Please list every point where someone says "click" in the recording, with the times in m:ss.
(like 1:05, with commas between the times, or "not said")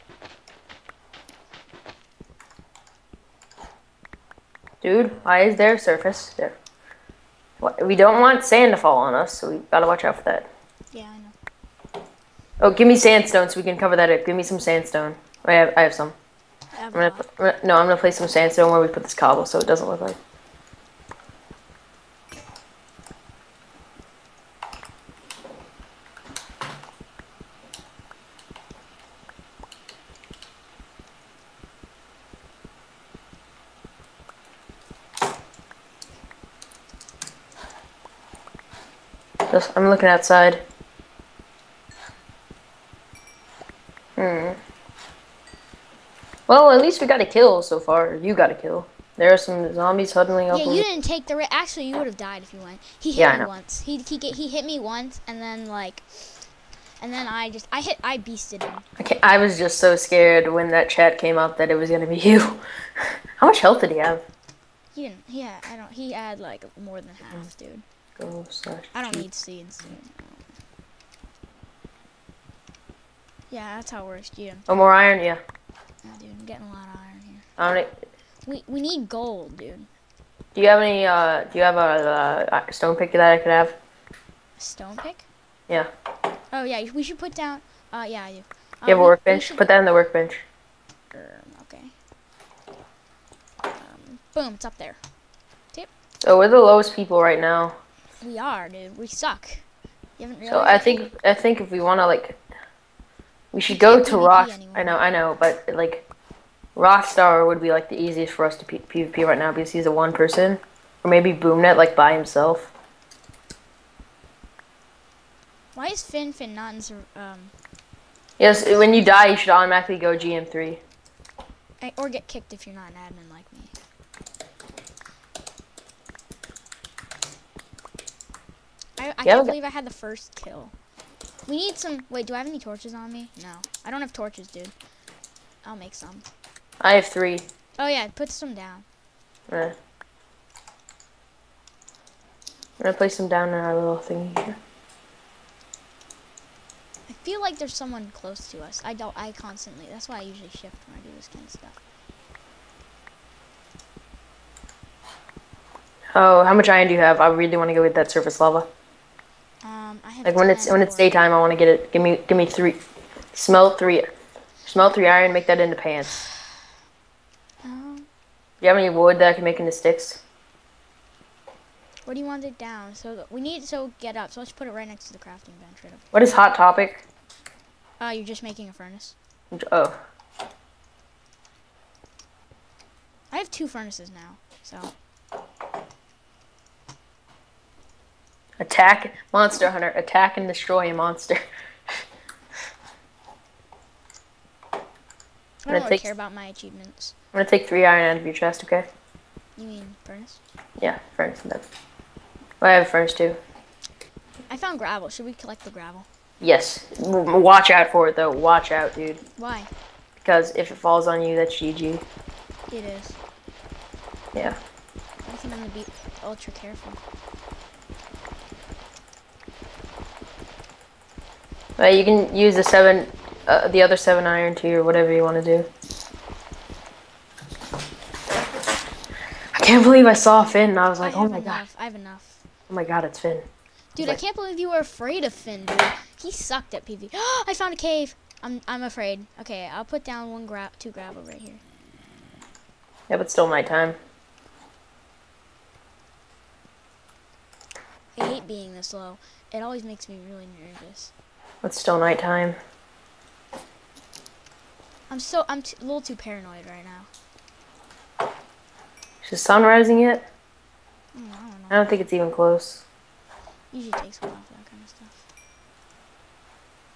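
not said.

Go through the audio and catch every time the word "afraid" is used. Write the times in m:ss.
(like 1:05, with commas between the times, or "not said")
3:54, 3:58.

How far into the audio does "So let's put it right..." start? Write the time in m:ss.
2:54.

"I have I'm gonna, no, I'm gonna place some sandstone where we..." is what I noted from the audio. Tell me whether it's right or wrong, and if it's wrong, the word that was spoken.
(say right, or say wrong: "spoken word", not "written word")
right.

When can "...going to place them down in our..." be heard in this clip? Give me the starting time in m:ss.
2:22.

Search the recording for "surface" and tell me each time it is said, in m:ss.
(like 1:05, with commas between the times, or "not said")
0:05, 2:38.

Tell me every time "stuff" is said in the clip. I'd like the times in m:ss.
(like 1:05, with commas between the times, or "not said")
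2:31, 4:24.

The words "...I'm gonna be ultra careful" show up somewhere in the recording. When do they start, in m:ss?
3:35.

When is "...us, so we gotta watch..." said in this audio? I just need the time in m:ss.
0:09.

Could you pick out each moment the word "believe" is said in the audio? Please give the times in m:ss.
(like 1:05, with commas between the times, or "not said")
2:09, 3:49, 3:54.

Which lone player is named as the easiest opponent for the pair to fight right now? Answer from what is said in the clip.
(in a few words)
Rockstar.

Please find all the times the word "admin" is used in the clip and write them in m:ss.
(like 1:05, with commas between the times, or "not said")
2:02.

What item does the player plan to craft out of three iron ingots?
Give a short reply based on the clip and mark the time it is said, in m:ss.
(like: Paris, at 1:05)
pants, at 2:45.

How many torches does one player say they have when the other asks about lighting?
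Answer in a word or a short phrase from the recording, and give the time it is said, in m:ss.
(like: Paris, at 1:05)
3, at 2:16.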